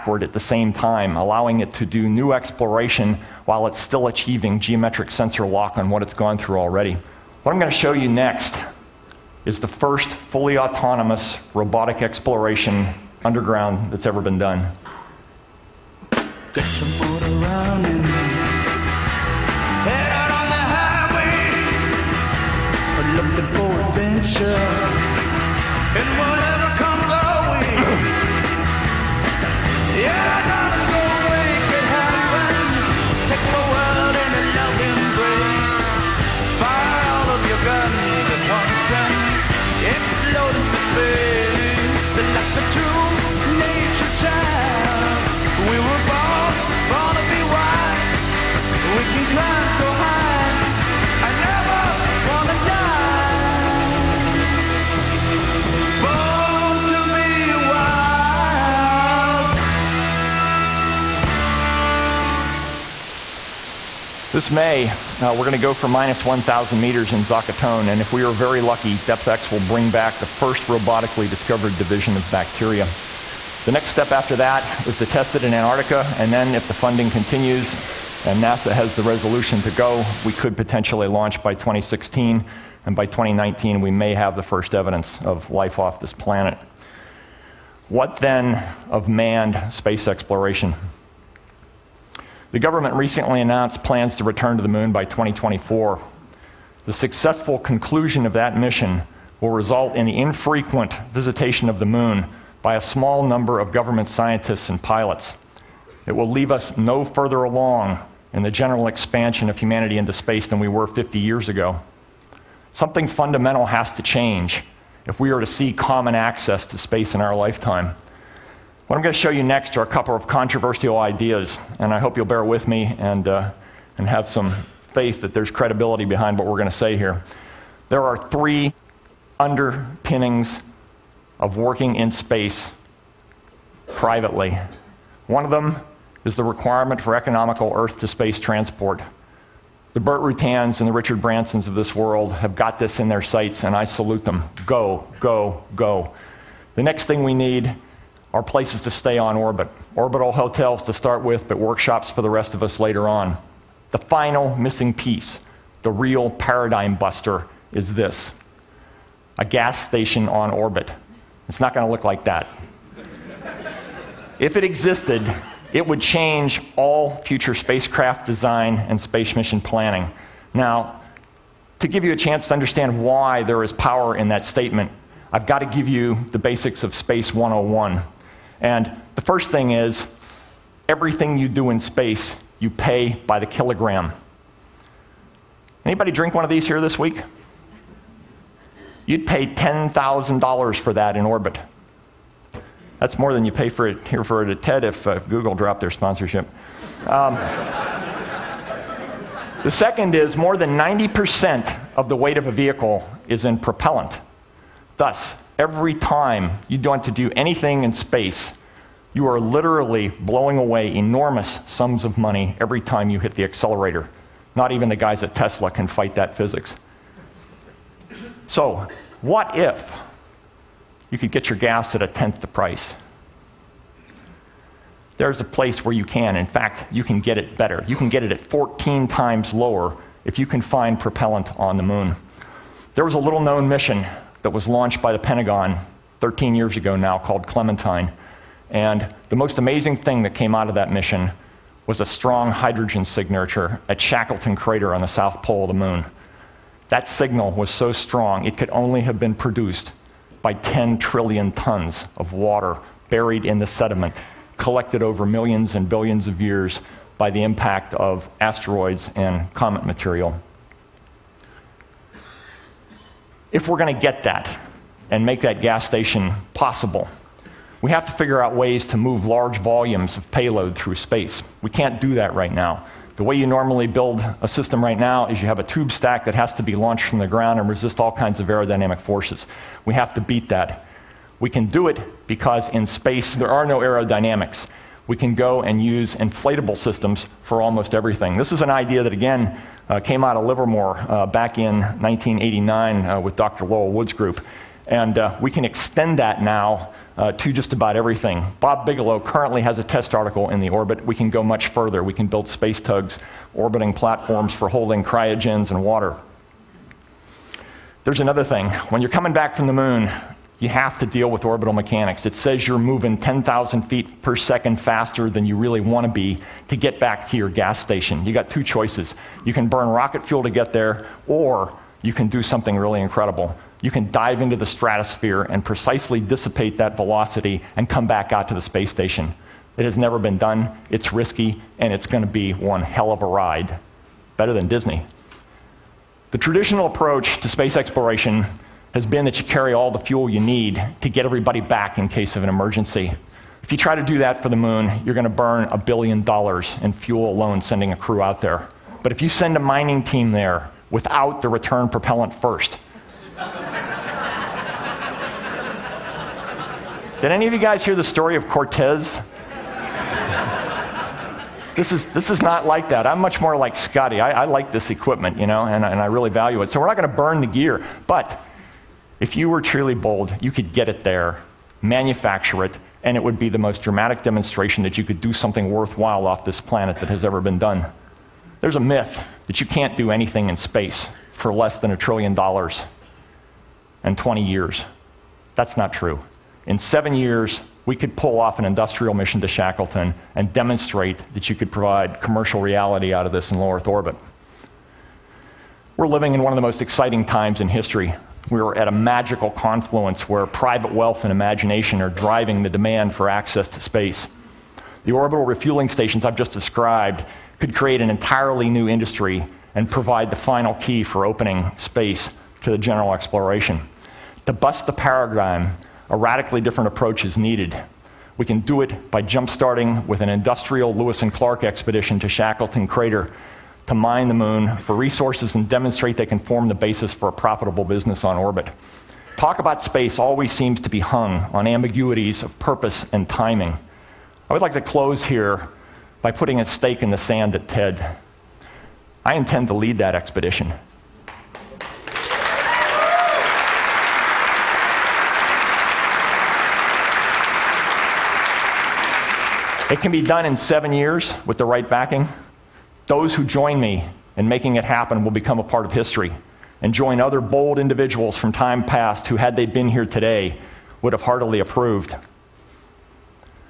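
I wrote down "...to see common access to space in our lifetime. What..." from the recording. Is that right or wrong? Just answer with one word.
right.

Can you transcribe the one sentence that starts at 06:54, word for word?
To bust the paradigm, a radically different approach is needed.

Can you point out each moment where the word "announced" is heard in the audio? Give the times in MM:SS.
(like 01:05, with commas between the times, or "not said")
01:33.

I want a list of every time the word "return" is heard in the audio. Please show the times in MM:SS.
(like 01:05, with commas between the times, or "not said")
01:34, 05:51.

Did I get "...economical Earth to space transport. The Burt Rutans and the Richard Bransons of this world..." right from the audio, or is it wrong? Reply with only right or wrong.
right.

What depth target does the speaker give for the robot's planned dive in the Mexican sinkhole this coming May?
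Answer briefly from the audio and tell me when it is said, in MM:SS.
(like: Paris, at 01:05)
-1,000 meters, at 01:05.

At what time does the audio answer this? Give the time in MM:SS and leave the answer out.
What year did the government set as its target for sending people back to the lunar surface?
01:35.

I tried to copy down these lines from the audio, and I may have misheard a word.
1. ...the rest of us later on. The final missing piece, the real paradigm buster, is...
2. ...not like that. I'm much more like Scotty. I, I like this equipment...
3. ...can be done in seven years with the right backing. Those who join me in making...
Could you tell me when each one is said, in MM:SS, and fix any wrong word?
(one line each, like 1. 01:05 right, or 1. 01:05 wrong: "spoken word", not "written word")
1. 02:32 right
2. 06:02 right
3. 07:29 right.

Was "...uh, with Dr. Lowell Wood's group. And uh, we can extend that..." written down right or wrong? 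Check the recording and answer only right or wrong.
right.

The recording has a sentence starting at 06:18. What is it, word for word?
There's a myth that you can't do anything in space for less than a trillion dollars and 20 years.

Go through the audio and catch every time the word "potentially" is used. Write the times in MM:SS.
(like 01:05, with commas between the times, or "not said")
01:20.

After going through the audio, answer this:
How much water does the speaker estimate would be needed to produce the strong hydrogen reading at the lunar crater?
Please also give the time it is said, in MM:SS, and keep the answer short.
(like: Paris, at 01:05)
10 trillion tons, at 04:10.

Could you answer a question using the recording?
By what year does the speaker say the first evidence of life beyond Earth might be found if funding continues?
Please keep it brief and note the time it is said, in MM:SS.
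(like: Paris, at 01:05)
2019, at 01:23.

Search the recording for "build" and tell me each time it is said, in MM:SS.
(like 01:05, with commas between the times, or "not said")
04:33, 05:02.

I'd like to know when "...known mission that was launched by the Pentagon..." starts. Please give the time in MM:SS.
03:53.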